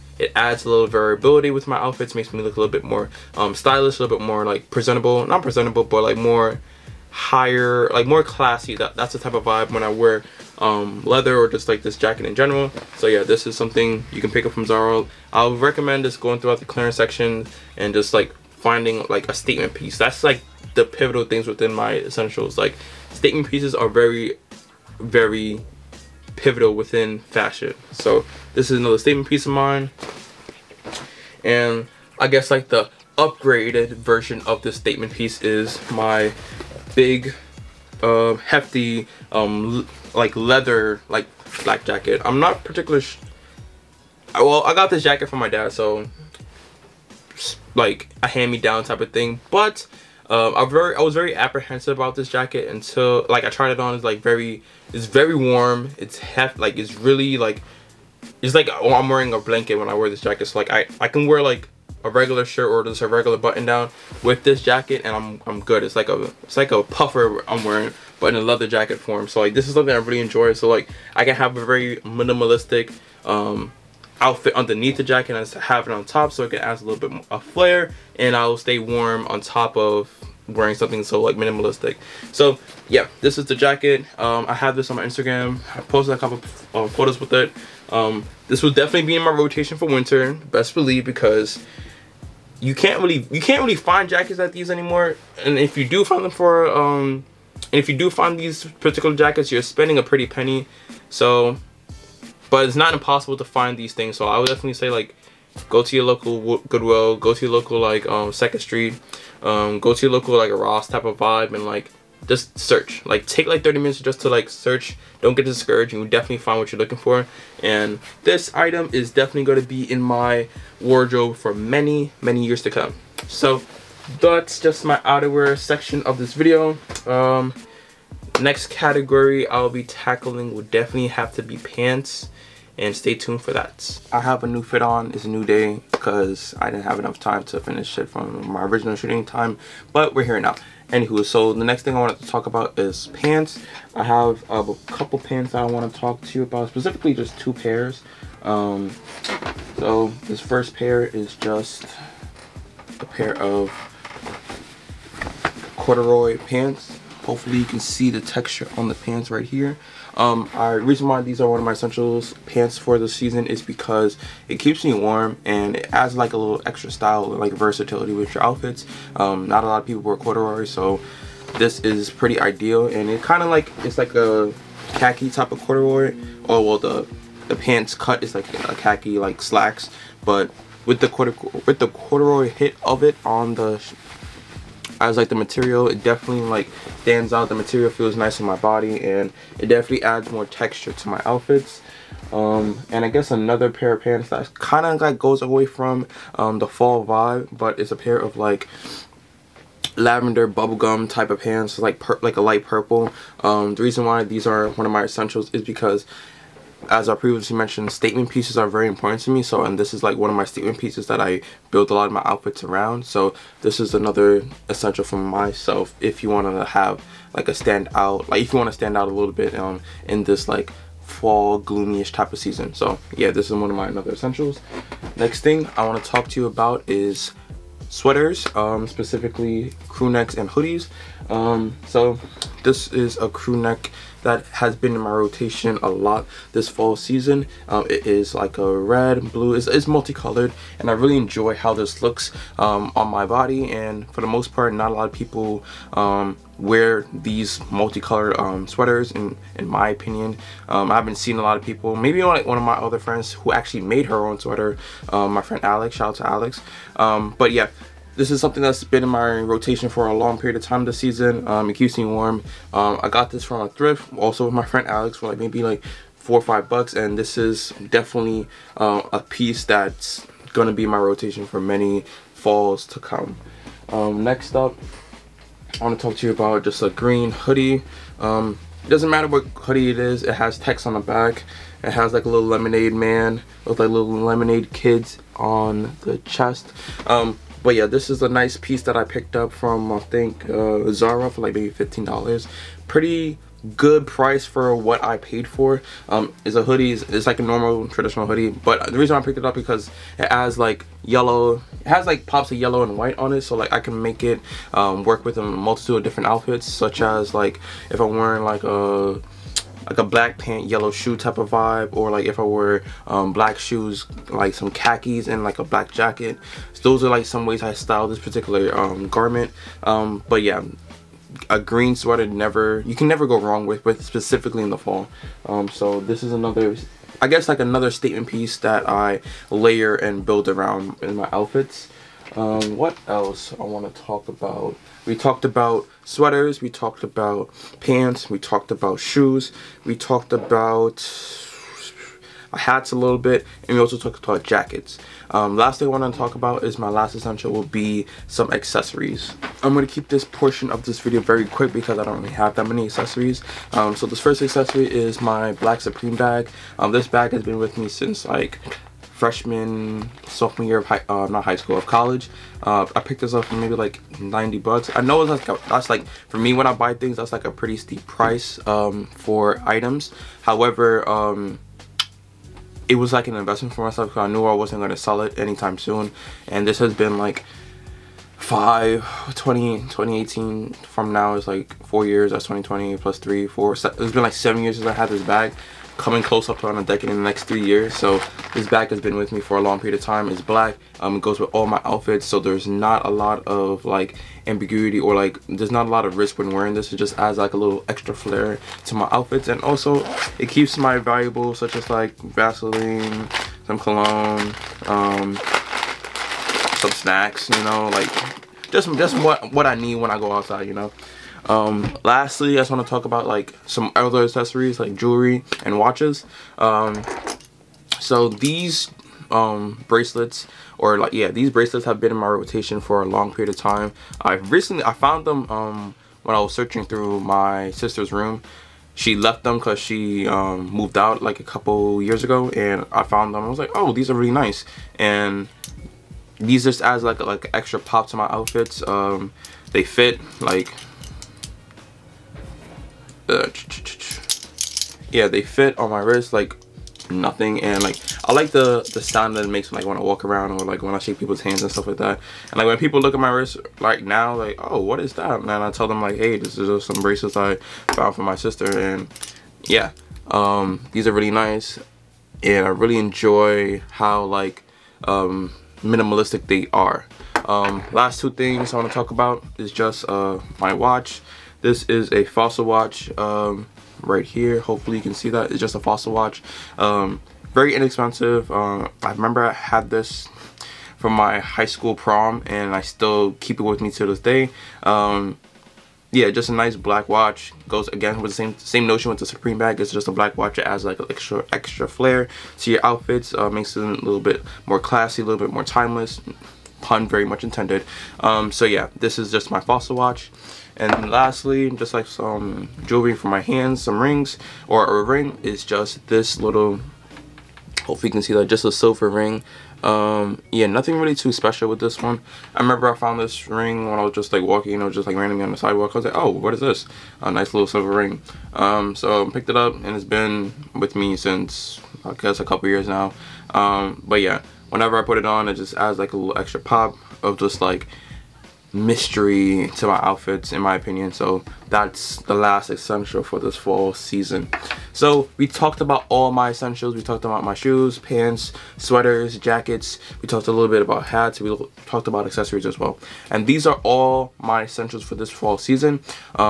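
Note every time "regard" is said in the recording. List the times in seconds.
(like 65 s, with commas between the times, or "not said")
not said.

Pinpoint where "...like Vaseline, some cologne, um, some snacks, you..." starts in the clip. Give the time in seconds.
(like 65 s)
401 s.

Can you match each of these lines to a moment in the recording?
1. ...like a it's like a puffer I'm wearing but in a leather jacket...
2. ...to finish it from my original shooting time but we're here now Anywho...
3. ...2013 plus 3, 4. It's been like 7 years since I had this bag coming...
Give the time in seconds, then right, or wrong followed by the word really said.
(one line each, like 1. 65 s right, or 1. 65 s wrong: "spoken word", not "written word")
1. 65 s right
2. 137 s right
3. 382 s wrong: "2020", not "2013".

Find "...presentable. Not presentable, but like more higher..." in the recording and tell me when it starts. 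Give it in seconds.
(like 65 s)
4 s.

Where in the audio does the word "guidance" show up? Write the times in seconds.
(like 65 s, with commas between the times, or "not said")
not said.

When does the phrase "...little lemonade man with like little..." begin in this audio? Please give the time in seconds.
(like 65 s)
282 s.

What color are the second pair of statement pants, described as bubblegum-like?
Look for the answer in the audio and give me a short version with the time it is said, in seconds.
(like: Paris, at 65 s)
Lavender, at 199 s.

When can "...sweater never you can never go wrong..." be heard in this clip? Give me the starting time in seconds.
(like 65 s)
321 s.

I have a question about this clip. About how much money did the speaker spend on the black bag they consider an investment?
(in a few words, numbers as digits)
$90.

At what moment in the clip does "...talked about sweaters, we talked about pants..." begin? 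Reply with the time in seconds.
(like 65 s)
335 s.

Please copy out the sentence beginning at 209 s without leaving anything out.
So, and this is like one of my statement pieces that I build a lot of my outfits around.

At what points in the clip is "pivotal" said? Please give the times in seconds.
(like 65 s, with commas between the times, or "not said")
20 s, 26 s.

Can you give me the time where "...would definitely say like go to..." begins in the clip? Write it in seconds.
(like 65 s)
104 s.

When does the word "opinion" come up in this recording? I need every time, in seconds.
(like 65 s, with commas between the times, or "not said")
249 s, 530 s.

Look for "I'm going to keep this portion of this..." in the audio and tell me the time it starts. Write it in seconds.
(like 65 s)
349 s.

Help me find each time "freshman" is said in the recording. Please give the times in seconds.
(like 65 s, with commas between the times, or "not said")
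359 s.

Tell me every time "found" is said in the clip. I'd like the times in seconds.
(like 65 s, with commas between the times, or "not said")
424 s, 433 s, 457 s, 512 s.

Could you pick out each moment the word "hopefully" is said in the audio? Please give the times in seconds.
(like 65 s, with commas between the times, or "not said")
157 s, 474 s, 507 s.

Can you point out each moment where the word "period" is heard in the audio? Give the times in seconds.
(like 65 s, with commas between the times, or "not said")
260 s, 389 s, 423 s.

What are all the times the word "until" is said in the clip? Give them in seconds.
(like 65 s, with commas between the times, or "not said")
52 s.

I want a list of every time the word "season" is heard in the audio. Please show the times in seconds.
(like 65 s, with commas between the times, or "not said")
163 s, 222 s, 236 s, 260 s, 533 s, 545 s.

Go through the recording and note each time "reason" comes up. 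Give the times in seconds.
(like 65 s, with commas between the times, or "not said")
160 s, 203 s, 298 s.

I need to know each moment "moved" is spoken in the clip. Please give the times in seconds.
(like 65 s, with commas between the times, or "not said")
430 s.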